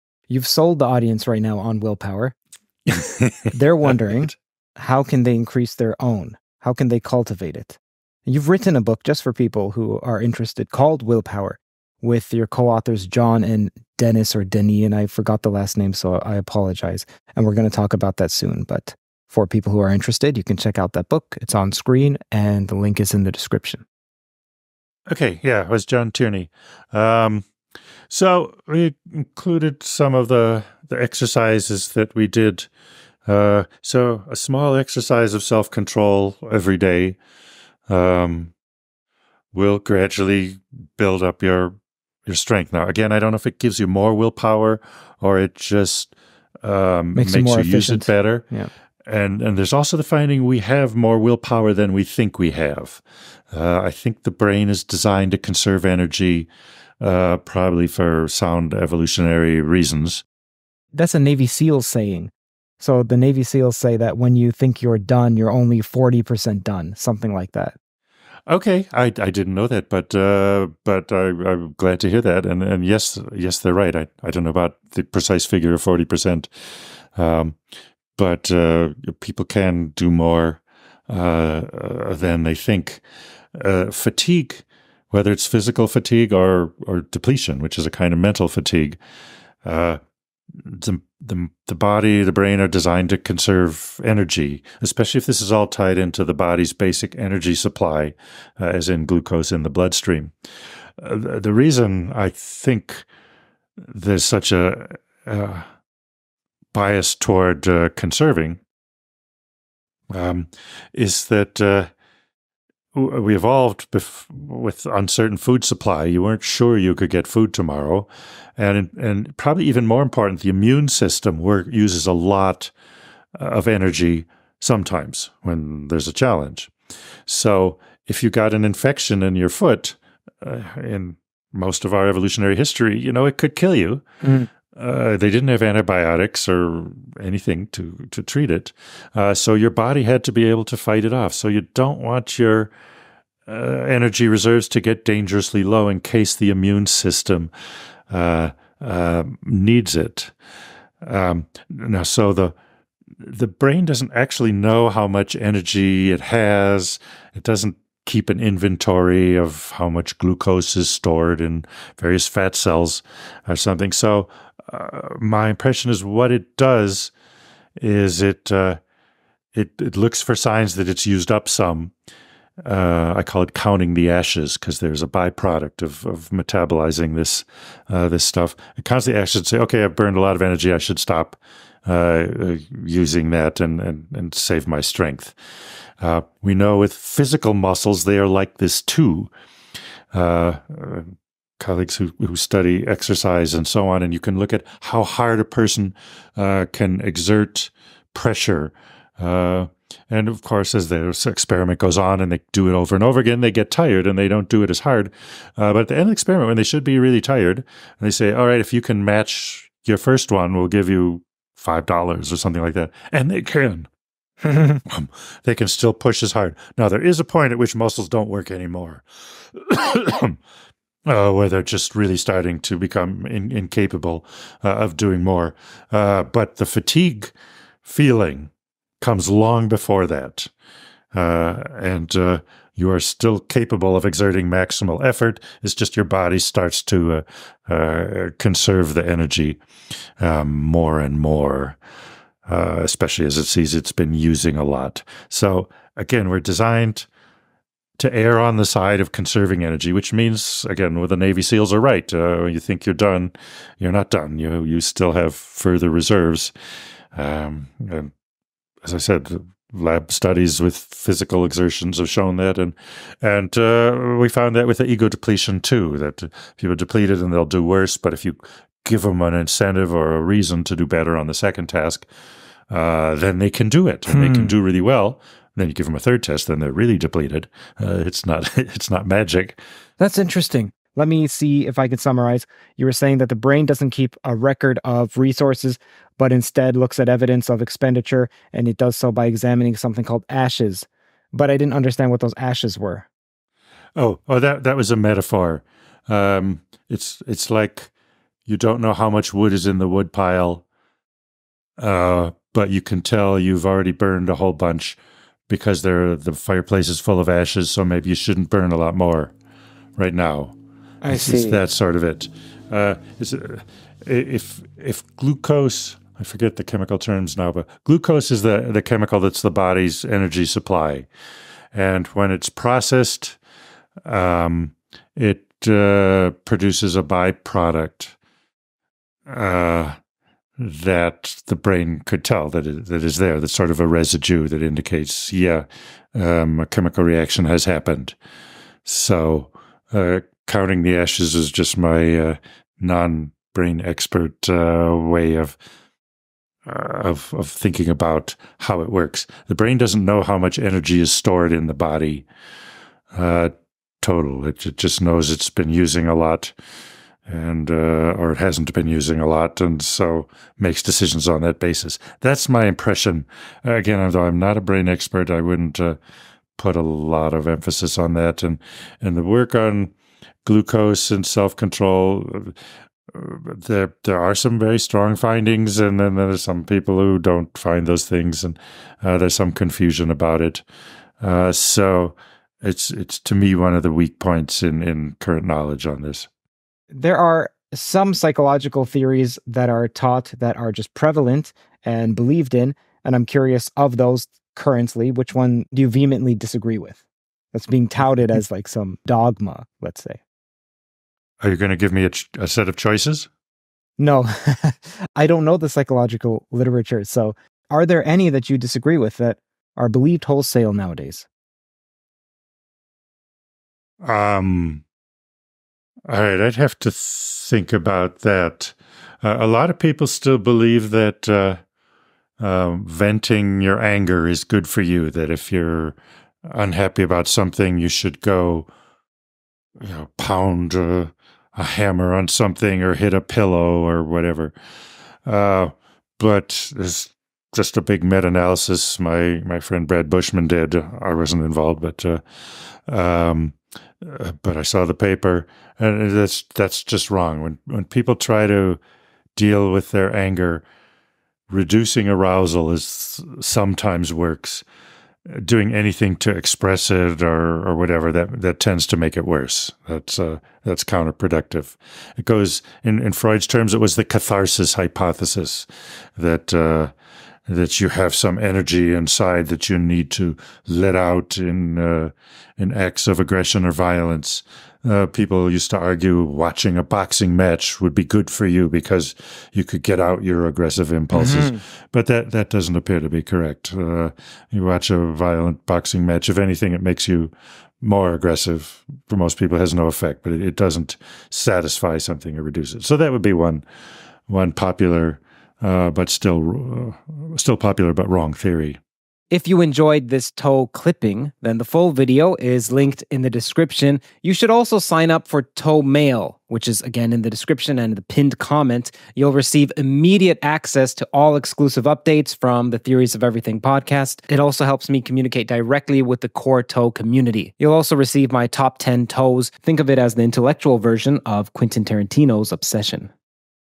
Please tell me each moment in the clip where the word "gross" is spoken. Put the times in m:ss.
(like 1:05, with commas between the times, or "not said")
not said.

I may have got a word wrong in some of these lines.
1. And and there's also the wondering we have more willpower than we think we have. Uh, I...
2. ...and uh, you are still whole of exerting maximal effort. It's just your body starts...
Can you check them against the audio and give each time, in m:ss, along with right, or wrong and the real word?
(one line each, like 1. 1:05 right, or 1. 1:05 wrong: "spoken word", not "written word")
1. 0:49 wrong: "finding", not "wondering"
2. 3:51 wrong: "capable", not "whole".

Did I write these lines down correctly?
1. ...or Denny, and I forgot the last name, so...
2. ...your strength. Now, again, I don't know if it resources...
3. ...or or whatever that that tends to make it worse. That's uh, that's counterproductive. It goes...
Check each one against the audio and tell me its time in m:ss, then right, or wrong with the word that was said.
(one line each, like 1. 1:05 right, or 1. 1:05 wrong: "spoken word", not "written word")
1. 0:14 right
2. 0:42 wrong: "gives", not "resources"
3. 7:37 right.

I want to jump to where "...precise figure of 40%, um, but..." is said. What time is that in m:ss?
1:15.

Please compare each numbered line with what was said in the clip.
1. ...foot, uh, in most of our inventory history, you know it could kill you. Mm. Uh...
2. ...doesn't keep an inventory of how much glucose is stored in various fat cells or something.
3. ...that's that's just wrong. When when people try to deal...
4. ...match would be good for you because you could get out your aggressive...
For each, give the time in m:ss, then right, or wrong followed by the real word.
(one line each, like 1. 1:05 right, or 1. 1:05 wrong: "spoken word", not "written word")
1. 2:09 wrong: "evolutionary", not "inventory"
2. 2:37 right
3. 7:26 right
4. 7:57 right.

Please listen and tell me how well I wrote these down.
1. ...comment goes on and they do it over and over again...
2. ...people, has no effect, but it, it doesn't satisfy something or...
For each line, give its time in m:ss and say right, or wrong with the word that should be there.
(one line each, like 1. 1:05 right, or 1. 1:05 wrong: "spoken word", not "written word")
1. 3:21 wrong: "experiment", not "comment"
2. 8:09 right.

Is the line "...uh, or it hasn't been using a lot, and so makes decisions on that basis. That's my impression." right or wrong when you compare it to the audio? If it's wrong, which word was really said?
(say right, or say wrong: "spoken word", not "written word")
right.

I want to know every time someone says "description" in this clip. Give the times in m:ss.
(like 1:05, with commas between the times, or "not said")
0:23, 8:23, 8:27.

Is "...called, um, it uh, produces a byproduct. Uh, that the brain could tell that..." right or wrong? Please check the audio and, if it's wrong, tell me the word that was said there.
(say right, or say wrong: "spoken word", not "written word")
wrong: "processed", not "called".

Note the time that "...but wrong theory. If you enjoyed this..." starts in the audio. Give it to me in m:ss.
8:17.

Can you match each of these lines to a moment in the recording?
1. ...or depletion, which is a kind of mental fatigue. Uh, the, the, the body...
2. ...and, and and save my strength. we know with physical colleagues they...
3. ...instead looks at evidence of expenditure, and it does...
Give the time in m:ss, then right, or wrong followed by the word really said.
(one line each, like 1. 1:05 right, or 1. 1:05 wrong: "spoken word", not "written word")
1. 1:26 right
2. 3:03 wrong: "muscles", not "colleagues"
3. 4:46 right.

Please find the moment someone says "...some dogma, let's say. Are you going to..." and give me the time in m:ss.
6:38.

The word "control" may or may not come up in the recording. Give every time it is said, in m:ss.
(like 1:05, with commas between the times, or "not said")
0:35, 6:11.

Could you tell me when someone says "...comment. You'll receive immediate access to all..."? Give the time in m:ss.
8:28.